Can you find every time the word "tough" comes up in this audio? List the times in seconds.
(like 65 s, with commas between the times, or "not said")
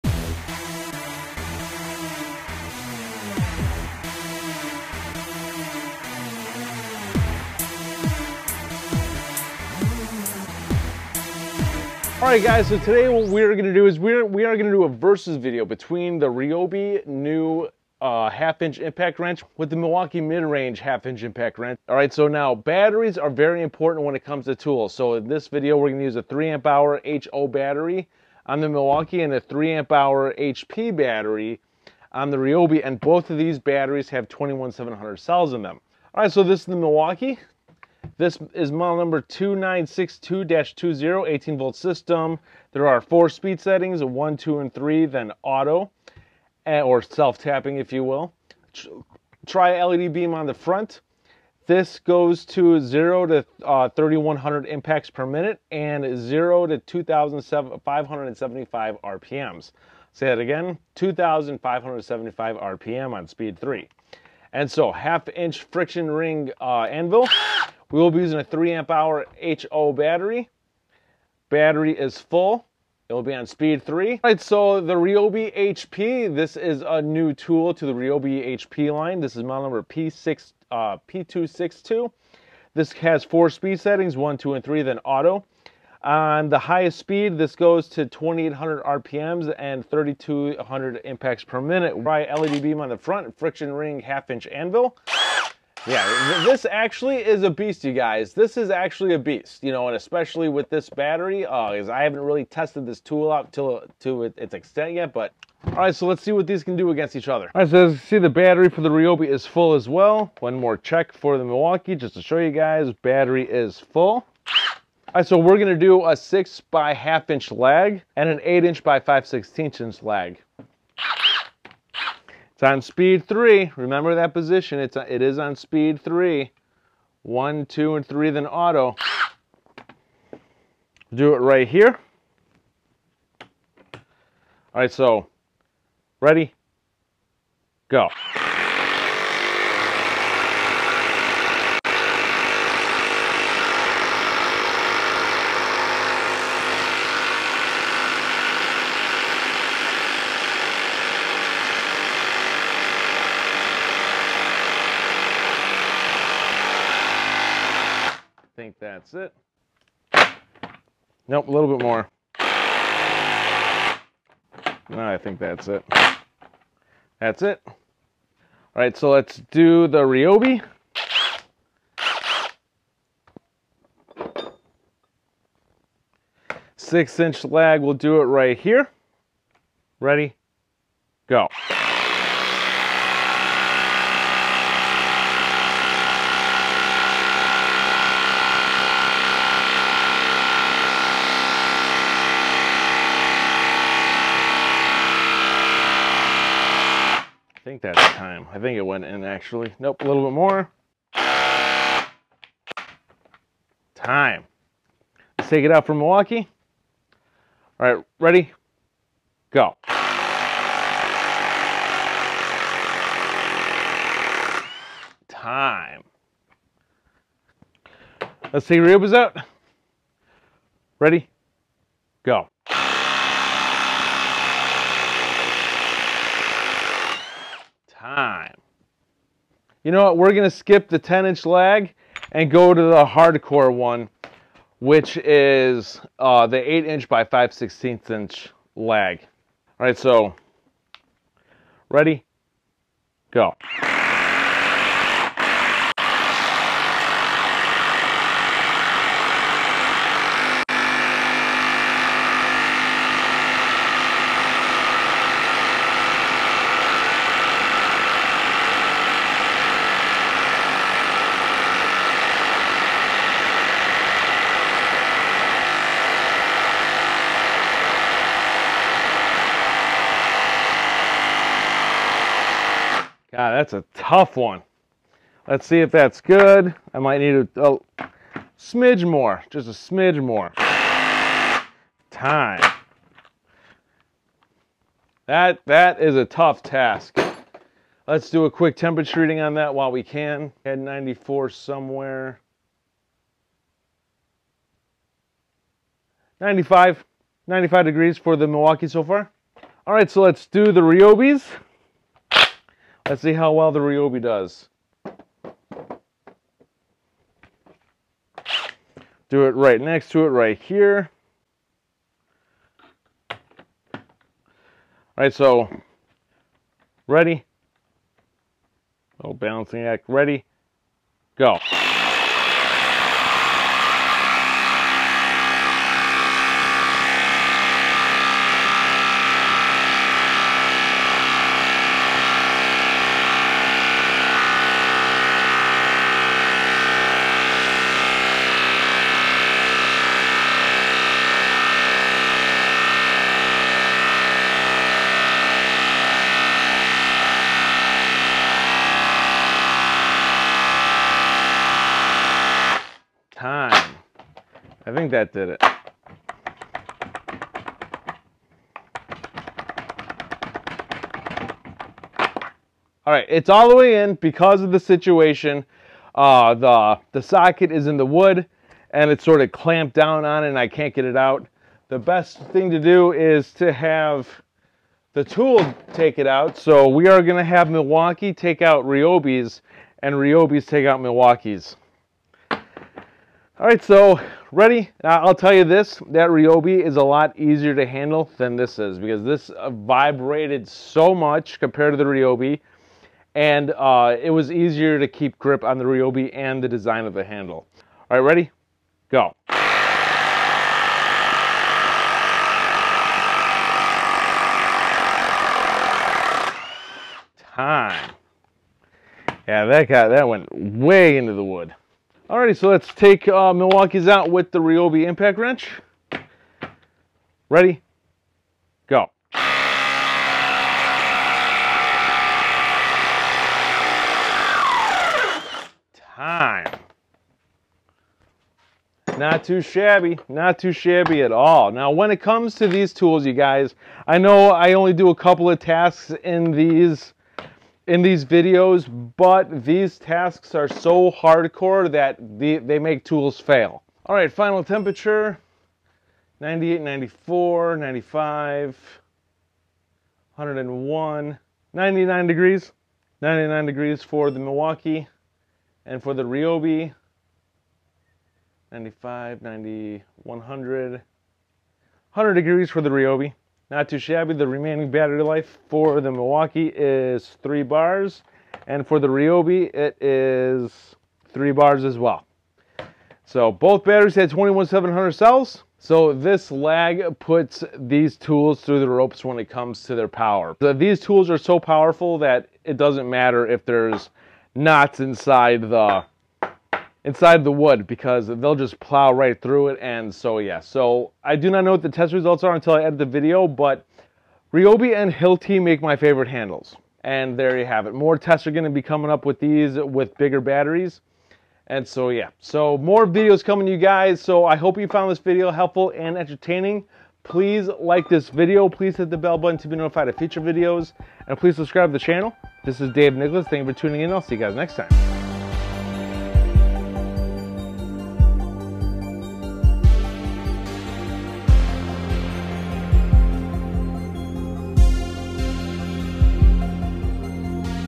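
273 s, 286 s.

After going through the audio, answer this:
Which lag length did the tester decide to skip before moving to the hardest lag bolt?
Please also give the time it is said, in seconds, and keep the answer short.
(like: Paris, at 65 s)
10 inch, at 230 s.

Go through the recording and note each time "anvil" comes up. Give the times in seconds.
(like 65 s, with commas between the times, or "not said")
66 s, 94 s.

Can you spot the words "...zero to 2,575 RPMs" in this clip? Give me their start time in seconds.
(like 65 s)
56 s.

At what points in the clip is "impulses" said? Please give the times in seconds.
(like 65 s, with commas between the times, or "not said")
not said.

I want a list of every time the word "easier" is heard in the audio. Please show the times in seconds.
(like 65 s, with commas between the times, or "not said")
387 s, 394 s.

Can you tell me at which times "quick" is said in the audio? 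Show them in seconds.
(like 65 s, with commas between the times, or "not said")
288 s.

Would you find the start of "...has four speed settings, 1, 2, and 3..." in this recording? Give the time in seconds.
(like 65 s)
82 s.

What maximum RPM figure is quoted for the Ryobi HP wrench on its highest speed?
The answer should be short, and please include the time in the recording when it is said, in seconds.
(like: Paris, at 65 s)
2,800, at 88 s.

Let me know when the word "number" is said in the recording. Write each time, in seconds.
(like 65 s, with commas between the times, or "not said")
38 s, 79 s.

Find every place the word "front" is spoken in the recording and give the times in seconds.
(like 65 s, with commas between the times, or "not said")
50 s, 92 s.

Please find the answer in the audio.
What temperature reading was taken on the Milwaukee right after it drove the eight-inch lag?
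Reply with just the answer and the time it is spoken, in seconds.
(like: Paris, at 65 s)
95 degrees, at 296 s.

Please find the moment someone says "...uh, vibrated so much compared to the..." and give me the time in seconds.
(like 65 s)
389 s.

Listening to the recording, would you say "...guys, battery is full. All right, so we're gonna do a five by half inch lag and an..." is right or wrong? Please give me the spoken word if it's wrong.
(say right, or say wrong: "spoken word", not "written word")
wrong: "six", not "five".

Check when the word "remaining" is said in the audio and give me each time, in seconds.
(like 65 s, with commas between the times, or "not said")
464 s.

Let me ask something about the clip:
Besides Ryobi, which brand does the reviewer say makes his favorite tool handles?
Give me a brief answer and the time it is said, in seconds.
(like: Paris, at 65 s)
Hilti, at 495 s.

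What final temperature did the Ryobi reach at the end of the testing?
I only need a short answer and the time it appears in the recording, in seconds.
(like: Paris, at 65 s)
100 degrees, at 460 s.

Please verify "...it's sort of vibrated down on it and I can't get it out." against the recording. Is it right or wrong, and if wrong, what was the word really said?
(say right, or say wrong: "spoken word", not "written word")
wrong: "clamped", not "vibrated".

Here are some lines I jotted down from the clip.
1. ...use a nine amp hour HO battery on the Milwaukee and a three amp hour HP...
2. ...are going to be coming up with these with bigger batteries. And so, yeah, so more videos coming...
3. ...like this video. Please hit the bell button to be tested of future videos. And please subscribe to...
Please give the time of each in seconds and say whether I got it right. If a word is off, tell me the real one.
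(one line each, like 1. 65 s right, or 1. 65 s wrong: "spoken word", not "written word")
1. 26 s wrong: "three", not "nine"
2. 498 s right
3. 507 s wrong: "notified", not "tested".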